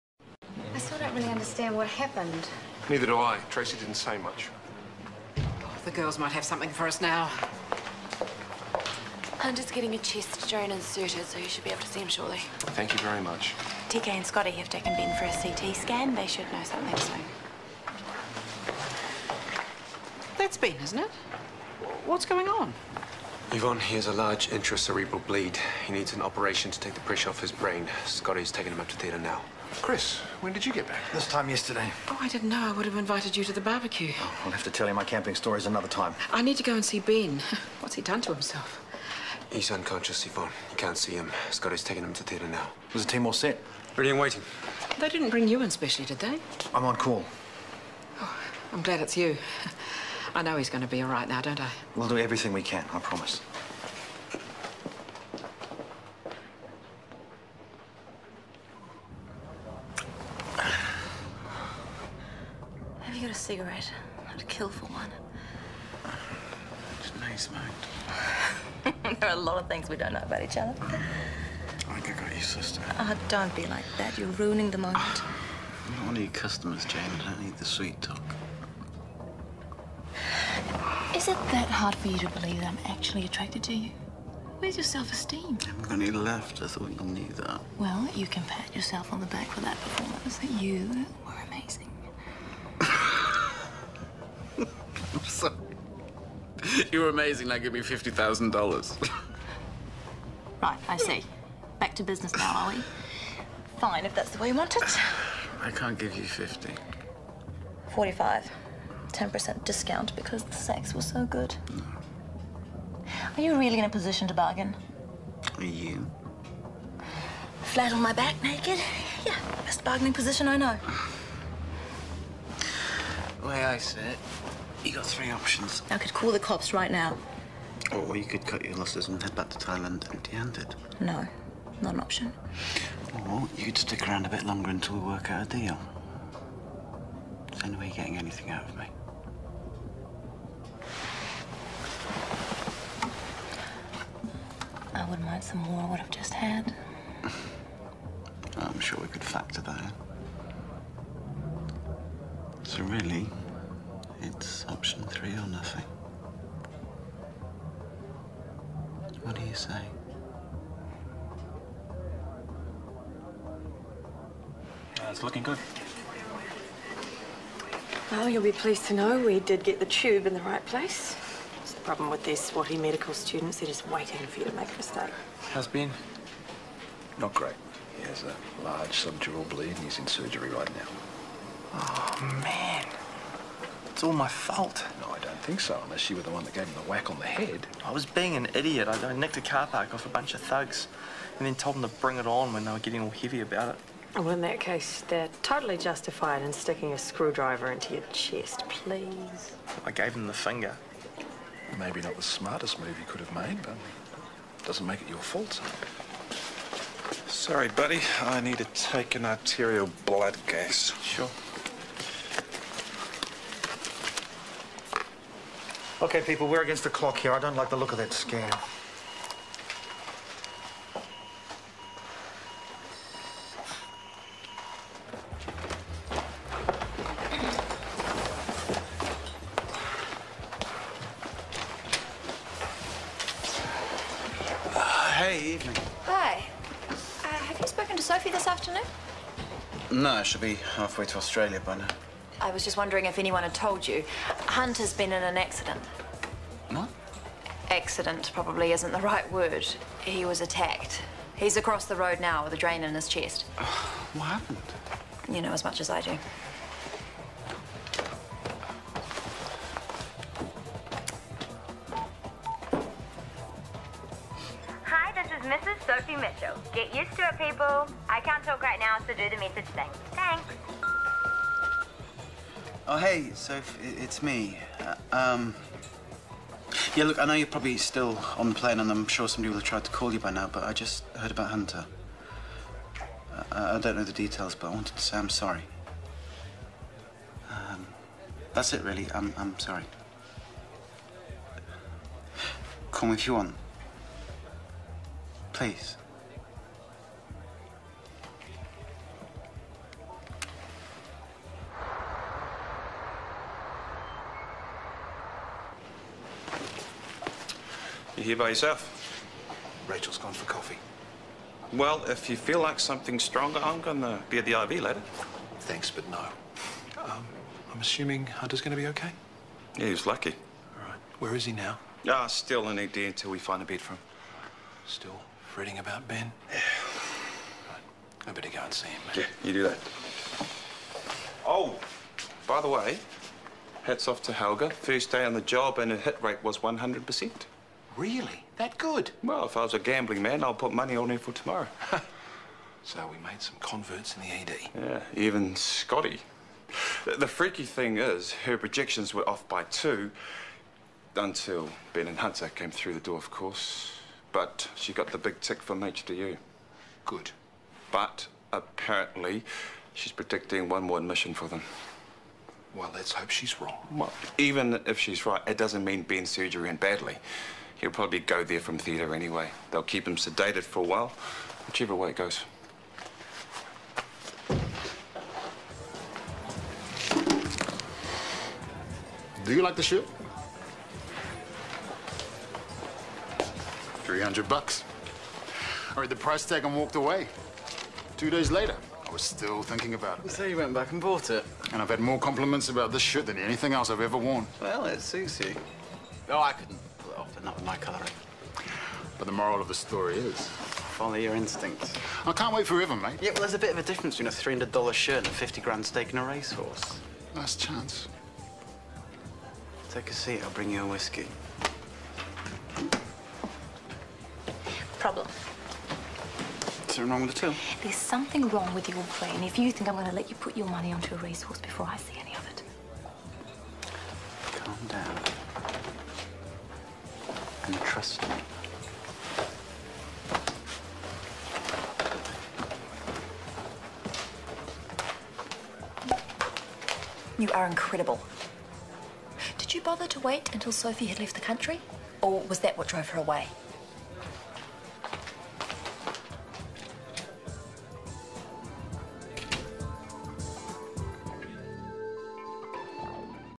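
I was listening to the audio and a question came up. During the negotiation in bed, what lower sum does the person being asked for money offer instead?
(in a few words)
45.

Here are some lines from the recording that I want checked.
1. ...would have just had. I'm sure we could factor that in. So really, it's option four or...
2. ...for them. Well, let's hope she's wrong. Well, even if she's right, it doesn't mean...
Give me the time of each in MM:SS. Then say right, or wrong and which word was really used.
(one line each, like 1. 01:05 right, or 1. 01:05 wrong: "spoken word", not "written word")
1. 02:25 wrong: "three", not "four"
2. 06:01 right.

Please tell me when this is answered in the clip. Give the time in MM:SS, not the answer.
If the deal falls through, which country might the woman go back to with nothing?
02:09.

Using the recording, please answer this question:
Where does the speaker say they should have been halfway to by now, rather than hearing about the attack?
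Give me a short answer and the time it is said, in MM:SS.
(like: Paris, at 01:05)
Australia, at 04:01.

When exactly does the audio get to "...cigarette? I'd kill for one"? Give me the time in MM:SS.
01:03.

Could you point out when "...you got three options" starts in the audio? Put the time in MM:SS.
02:04.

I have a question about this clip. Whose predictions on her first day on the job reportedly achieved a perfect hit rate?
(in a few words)
Helga.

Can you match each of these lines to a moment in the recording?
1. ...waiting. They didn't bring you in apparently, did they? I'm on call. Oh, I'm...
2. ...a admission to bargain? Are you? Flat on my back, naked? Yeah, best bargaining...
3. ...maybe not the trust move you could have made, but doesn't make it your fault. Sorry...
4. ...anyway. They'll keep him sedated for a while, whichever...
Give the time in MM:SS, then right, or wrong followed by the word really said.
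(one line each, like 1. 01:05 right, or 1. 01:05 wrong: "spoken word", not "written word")
1. 00:44 wrong: "specially", not "apparently"
2. 01:53 wrong: "position", not "admission"
3. 03:21 wrong: "smartest", not "trust"
4. 06:09 right.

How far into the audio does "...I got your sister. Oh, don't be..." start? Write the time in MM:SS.
01:12.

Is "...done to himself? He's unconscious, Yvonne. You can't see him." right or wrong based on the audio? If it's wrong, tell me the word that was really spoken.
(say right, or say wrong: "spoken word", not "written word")
right.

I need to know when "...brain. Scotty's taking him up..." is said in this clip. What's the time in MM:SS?
00:27.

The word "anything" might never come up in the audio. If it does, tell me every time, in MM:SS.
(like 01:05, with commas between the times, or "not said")
02:18, 06:33.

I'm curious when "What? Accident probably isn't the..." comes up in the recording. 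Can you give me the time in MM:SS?
04:06.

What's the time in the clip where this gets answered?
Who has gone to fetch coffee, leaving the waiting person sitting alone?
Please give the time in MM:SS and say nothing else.
05:09.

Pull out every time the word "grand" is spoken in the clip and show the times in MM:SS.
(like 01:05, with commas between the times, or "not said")
06:45.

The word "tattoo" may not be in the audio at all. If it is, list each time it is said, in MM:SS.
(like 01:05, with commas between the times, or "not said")
not said.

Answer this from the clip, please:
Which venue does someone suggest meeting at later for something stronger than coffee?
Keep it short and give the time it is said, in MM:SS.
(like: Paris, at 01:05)
The IV, at 05:14.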